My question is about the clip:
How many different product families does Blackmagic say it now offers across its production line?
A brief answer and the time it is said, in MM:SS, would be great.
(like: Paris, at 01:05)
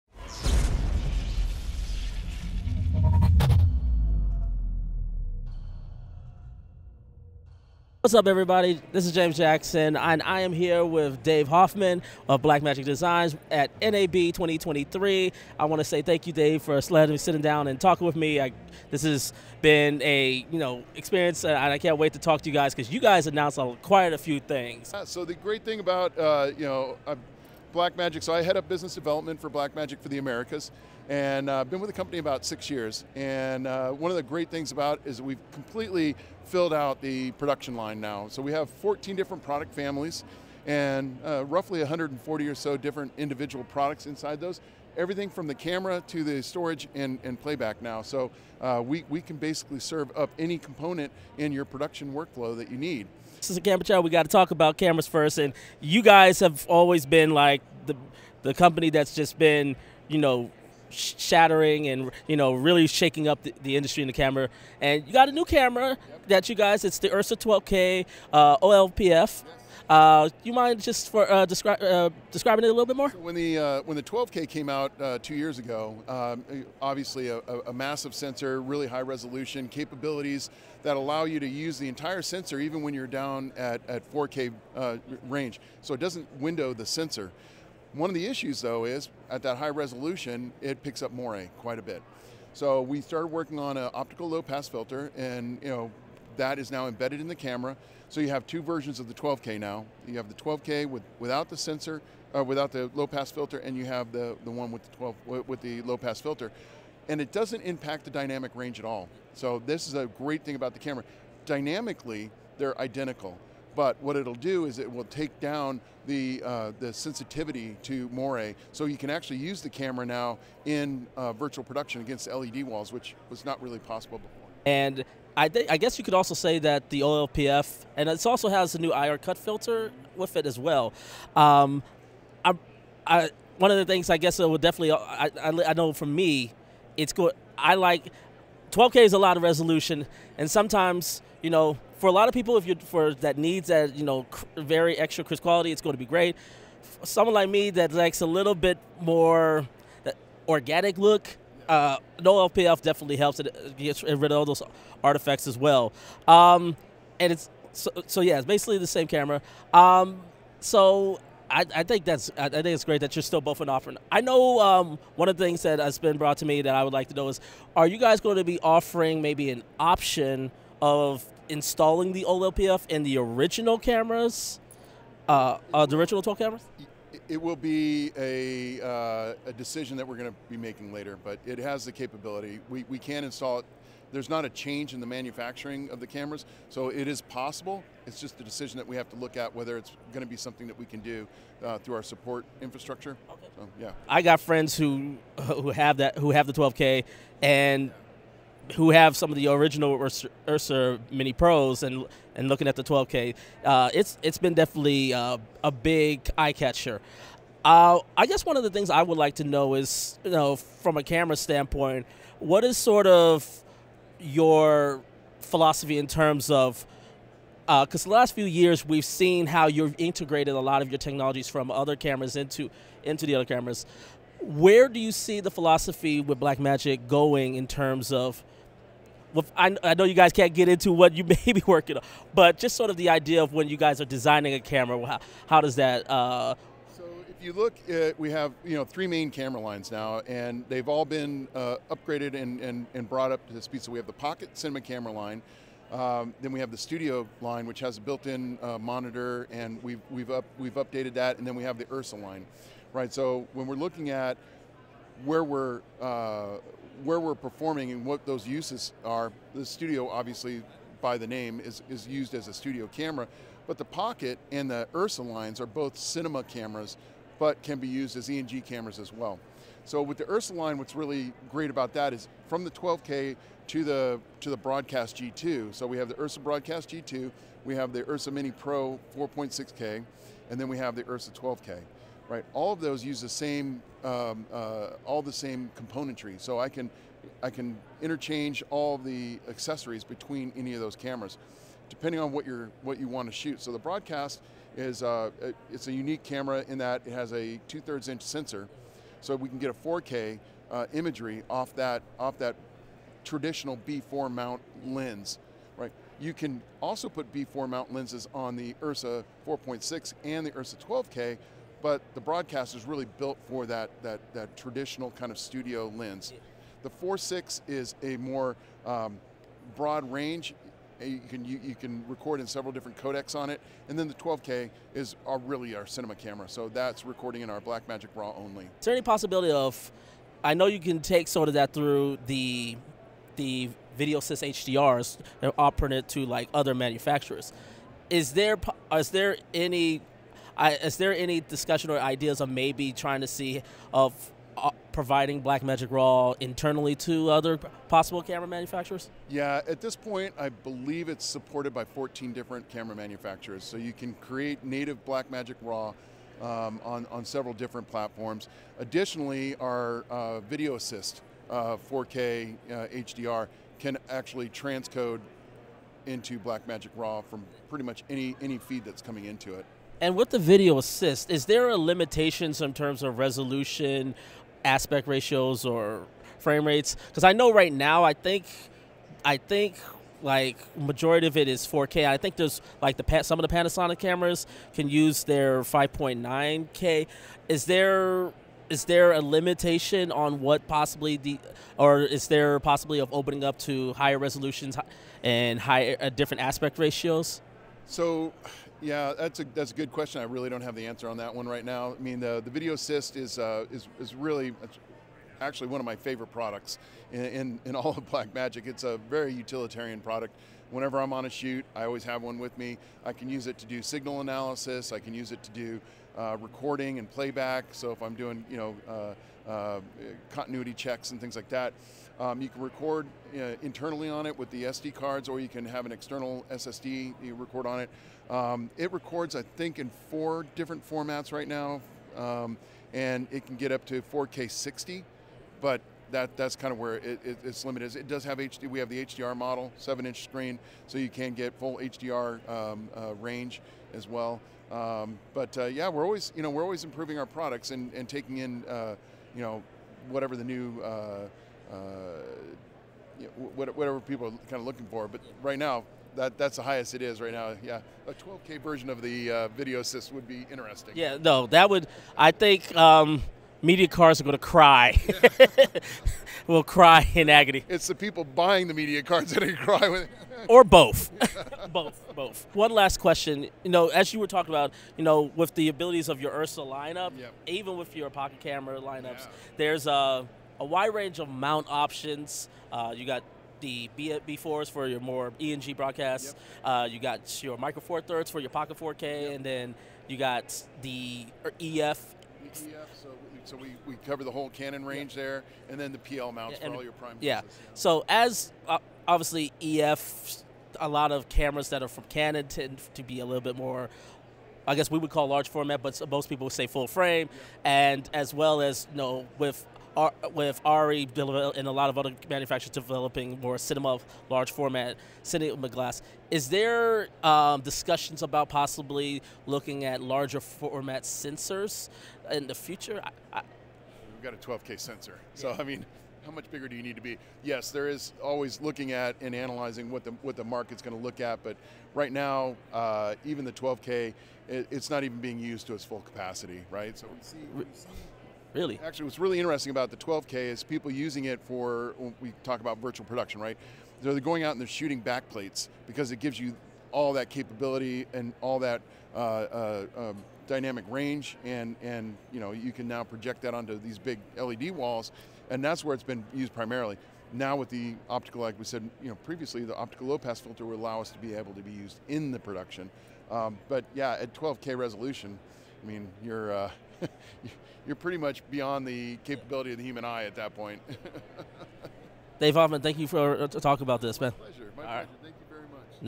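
14, at 00:38.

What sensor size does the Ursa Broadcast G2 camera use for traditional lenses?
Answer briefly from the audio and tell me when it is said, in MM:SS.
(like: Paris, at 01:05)
two-thirds inch, at 04:57.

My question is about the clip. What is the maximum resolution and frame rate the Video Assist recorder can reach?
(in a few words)
4K 60.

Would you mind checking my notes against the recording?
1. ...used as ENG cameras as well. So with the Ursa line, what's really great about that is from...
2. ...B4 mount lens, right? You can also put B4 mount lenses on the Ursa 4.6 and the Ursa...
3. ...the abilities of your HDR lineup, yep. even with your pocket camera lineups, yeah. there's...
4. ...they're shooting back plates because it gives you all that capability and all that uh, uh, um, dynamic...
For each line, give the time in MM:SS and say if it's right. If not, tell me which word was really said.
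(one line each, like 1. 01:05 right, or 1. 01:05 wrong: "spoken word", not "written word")
1. 04:27 right
2. 05:03 right
3. 07:55 wrong: "Ursa", not "HDR"
4. 09:04 right.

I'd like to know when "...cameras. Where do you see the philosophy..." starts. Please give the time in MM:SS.
03:43.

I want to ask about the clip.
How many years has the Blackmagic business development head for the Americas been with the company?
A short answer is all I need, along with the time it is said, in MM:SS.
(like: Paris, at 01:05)
6, at 00:32.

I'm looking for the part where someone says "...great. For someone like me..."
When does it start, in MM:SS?
02:26.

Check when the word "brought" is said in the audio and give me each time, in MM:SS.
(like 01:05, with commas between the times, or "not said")
02:46, 04:03.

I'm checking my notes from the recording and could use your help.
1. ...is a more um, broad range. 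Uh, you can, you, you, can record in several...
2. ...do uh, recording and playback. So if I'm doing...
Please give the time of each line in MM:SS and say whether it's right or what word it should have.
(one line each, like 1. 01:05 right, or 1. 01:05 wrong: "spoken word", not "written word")
1. 05:17 right
2. 06:55 right.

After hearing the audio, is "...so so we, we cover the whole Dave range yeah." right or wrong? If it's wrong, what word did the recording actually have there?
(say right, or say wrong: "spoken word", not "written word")
wrong: "Canon", not "Dave".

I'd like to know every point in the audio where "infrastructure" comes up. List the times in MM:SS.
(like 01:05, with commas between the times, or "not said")
03:12.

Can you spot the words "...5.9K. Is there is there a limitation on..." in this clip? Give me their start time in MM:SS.
06:25.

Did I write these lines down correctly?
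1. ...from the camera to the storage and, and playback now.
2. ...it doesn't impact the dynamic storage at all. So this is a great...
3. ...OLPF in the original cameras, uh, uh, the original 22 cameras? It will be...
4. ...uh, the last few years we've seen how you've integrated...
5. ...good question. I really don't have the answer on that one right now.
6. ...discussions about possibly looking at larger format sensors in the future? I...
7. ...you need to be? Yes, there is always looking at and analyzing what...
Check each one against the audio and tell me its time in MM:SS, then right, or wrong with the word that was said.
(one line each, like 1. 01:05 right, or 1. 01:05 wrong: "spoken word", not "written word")
1. 00:45 right
2. 01:47 wrong: "range", not "storage"
3. 02:52 wrong: "12", not "22"
4. 03:38 right
5. 06:39 right
6. 08:37 right
7. 08:46 right.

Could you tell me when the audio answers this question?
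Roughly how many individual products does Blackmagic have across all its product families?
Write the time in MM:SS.
00:41.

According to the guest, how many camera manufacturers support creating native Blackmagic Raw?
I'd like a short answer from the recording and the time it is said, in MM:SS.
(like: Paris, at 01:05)
14, at 05:51.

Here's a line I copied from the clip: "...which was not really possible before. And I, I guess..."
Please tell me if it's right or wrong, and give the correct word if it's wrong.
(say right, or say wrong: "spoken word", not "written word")
right.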